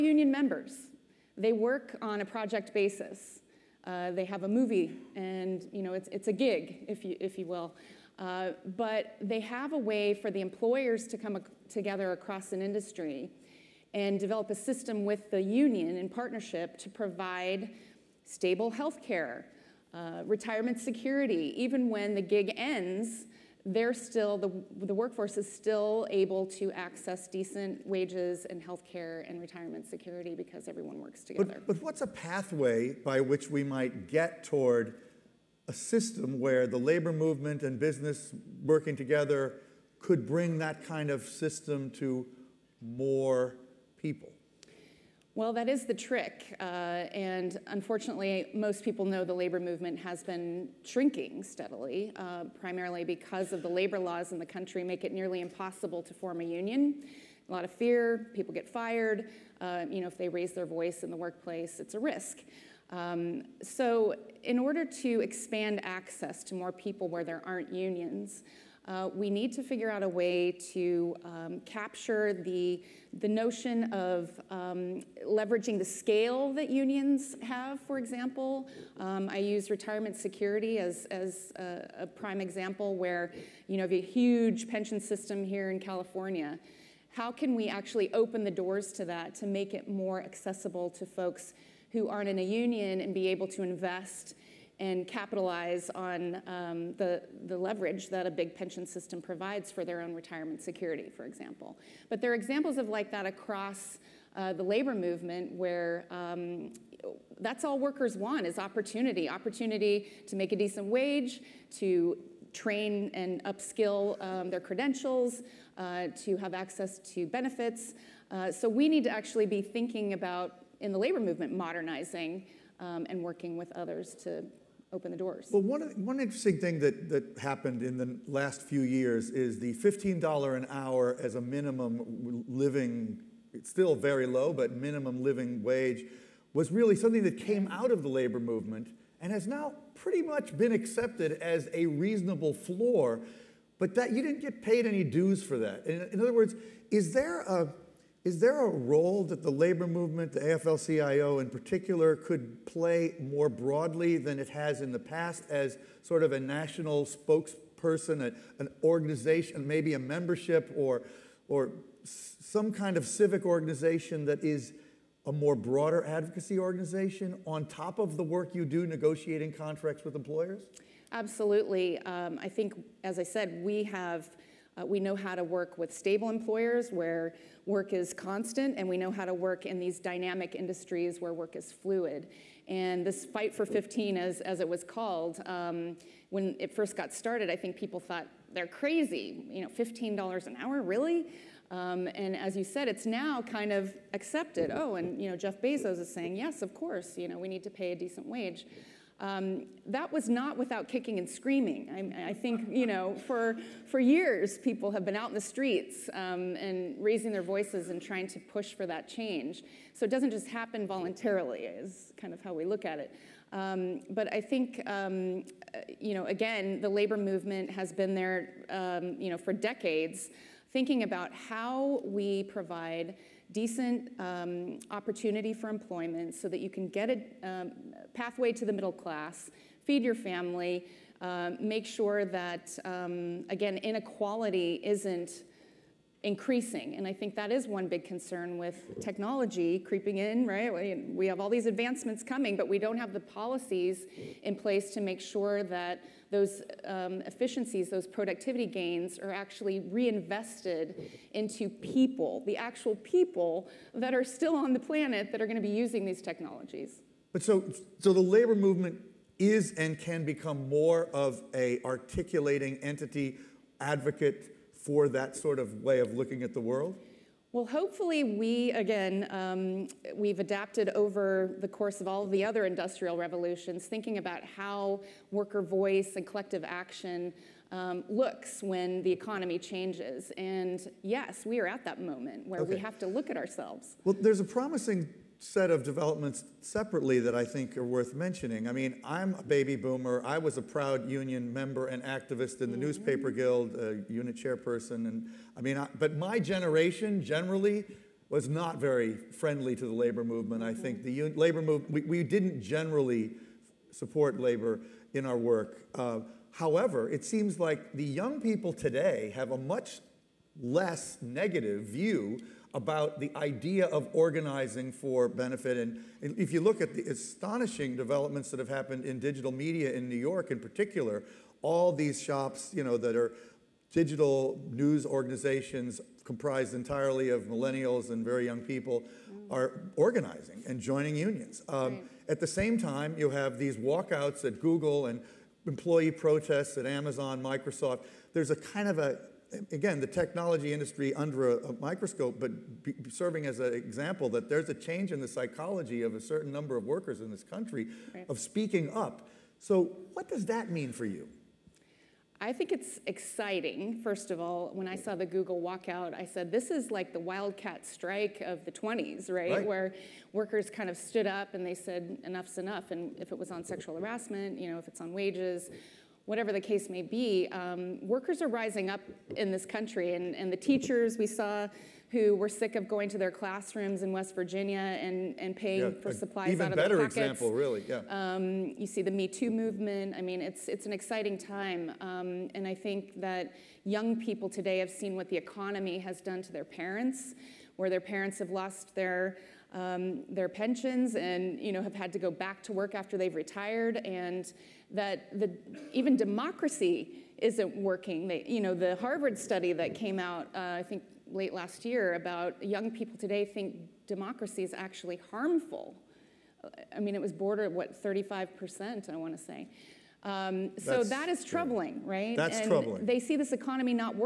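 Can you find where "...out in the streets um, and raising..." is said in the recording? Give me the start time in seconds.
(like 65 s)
205 s.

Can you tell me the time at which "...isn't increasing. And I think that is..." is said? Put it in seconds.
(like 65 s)
234 s.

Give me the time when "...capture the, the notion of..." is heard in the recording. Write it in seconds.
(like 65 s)
71 s.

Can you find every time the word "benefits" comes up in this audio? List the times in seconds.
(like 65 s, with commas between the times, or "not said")
117 s, 315 s.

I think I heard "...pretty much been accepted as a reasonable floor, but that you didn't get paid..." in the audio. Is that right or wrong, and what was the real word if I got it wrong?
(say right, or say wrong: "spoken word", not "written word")
right.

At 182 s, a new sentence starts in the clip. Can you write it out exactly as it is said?
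And this fight for 15, as, as it was called, um, when it first got started, I think people thought they're crazy.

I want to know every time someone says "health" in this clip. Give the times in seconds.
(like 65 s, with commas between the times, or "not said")
18 s, 28 s.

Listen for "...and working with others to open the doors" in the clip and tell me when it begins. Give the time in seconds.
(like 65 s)
123 s.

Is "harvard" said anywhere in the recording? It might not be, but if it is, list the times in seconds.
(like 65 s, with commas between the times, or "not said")
398 s.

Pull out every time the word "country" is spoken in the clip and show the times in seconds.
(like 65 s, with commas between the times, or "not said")
54 s, 347 s, 369 s.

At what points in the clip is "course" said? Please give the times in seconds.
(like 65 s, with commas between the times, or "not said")
196 s, 271 s.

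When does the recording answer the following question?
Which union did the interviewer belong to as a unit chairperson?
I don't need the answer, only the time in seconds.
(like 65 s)
292 s.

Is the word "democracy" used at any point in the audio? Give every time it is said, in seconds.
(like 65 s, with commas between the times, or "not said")
396 s, 404 s.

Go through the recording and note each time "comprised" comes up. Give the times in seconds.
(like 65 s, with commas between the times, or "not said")
326 s.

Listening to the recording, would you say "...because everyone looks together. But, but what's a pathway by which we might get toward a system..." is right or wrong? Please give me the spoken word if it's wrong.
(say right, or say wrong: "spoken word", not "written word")
wrong: "works", not "looks".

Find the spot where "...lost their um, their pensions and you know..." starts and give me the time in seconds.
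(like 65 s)
388 s.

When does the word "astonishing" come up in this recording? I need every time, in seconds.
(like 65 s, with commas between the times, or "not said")
317 s.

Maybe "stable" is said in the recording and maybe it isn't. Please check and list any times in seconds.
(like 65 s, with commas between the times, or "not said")
18 s, 175 s.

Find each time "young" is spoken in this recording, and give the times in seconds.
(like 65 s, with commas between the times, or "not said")
308 s, 328 s, 383 s, 402 s.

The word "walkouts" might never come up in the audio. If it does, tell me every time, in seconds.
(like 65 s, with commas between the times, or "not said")
333 s, 355 s.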